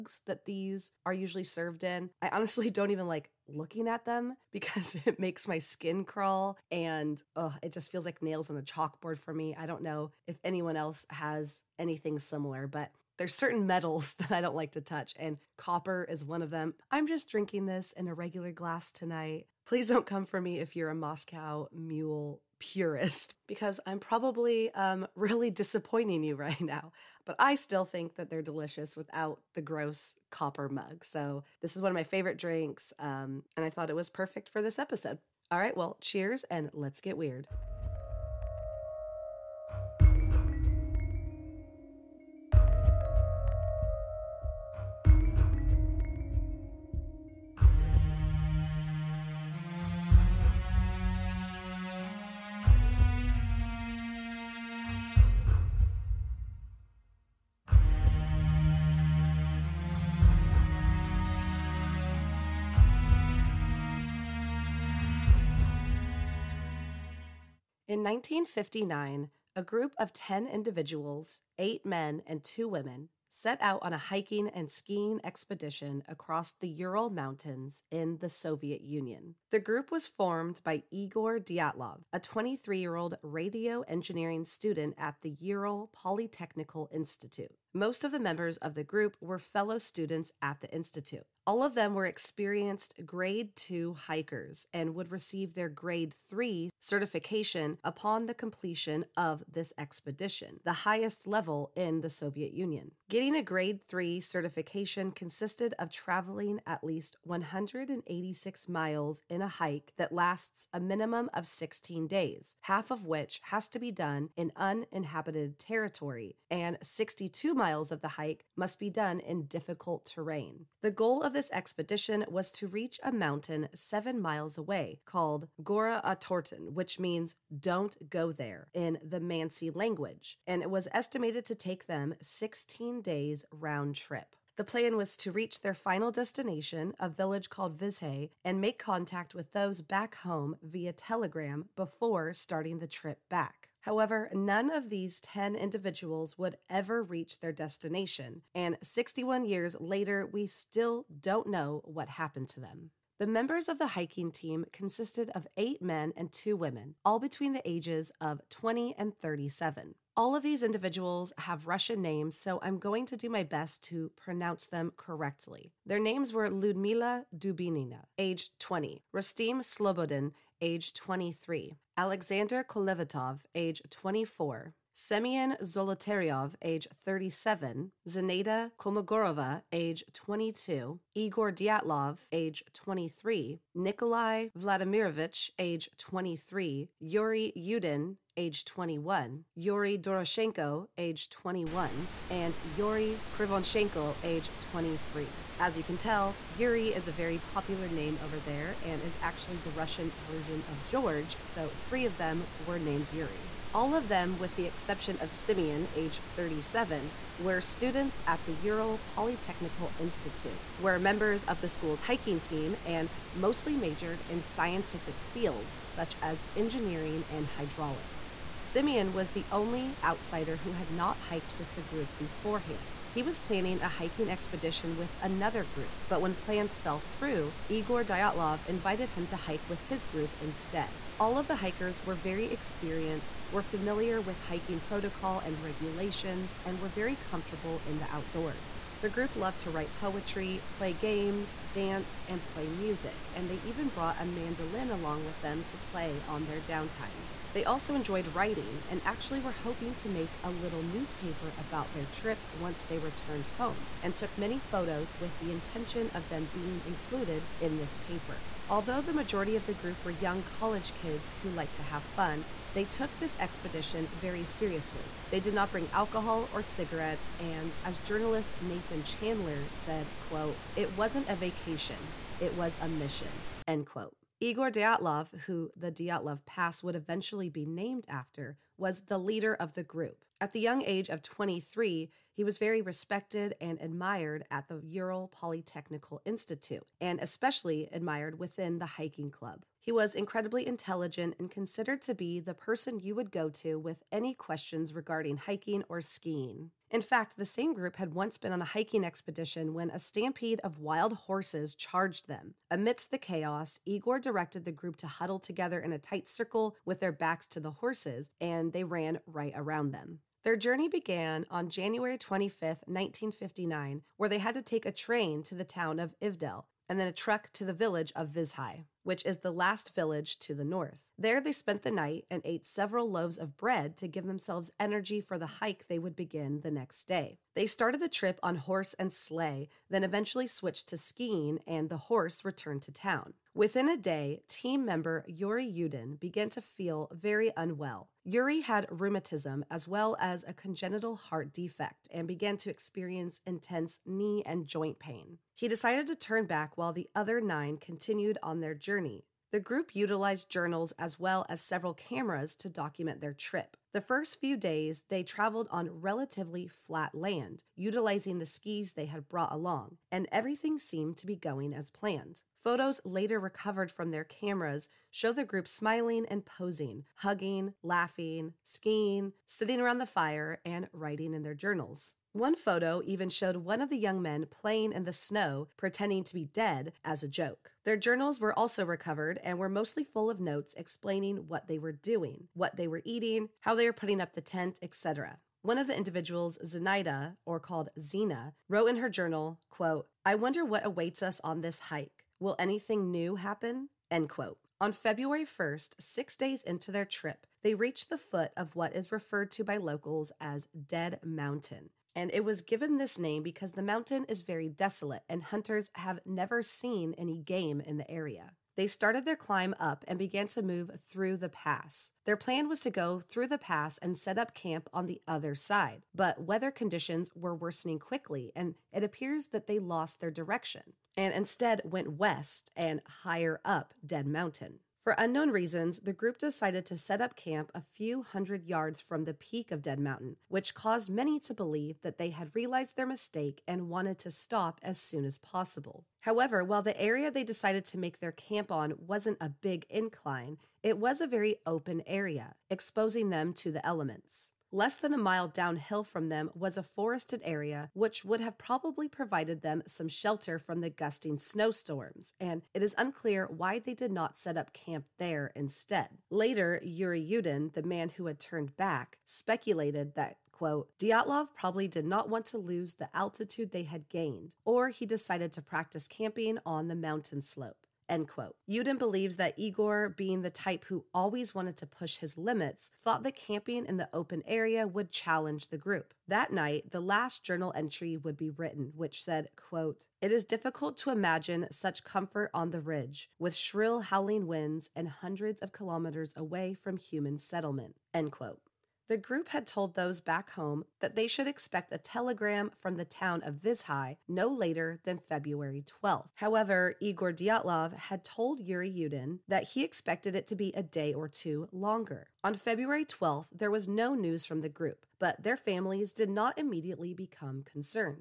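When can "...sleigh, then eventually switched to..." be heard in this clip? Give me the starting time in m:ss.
5:29.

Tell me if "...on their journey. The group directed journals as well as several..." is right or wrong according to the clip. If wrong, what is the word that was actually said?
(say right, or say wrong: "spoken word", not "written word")
wrong: "utilized", not "directed".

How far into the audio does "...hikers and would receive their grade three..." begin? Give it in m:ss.
1:33.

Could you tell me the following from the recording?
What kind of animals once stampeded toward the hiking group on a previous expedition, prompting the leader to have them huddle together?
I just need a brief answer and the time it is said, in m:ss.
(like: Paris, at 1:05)
wild horses, at 5:00.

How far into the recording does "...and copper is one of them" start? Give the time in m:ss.
0:15.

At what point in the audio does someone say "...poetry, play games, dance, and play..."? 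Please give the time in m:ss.
3:59.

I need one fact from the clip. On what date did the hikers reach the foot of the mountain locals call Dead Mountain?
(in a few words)
February 1st.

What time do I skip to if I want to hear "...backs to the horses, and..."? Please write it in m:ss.
5:07.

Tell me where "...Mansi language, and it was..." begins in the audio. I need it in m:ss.
2:09.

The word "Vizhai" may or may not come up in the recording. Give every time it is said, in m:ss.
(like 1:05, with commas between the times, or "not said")
2:17, 5:18, 8:13.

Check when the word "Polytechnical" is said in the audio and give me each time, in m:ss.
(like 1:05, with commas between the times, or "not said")
1:25, 3:29, 4:45.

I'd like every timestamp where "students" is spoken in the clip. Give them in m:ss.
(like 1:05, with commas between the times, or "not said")
1:24, 1:29, 3:27.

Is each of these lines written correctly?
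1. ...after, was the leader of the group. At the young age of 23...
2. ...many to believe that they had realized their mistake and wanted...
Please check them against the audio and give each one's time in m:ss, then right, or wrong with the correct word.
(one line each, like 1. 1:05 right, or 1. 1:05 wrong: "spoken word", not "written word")
1. 4:38 right
2. 7:11 right.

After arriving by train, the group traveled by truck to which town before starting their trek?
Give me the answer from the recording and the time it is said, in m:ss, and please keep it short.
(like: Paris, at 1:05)
Ivdel, at 5:16.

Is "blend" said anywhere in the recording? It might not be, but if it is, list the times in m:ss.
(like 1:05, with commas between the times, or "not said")
not said.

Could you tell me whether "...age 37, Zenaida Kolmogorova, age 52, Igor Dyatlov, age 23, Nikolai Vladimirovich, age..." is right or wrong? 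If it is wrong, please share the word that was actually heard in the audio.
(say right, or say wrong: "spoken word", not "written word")
wrong: "22", not "52".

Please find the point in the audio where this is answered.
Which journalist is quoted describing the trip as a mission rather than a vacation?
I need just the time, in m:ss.
4:28.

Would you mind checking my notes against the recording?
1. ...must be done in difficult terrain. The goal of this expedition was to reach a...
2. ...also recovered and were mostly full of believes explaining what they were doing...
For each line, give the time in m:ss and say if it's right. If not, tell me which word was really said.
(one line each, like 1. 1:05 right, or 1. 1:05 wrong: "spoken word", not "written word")
1. 1:58 right
2. 6:18 wrong: "notes", not "believes".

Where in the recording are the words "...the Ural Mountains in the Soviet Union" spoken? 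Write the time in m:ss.
1:16.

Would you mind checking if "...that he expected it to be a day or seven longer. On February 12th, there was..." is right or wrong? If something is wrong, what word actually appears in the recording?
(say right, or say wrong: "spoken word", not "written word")
wrong: "two", not "seven".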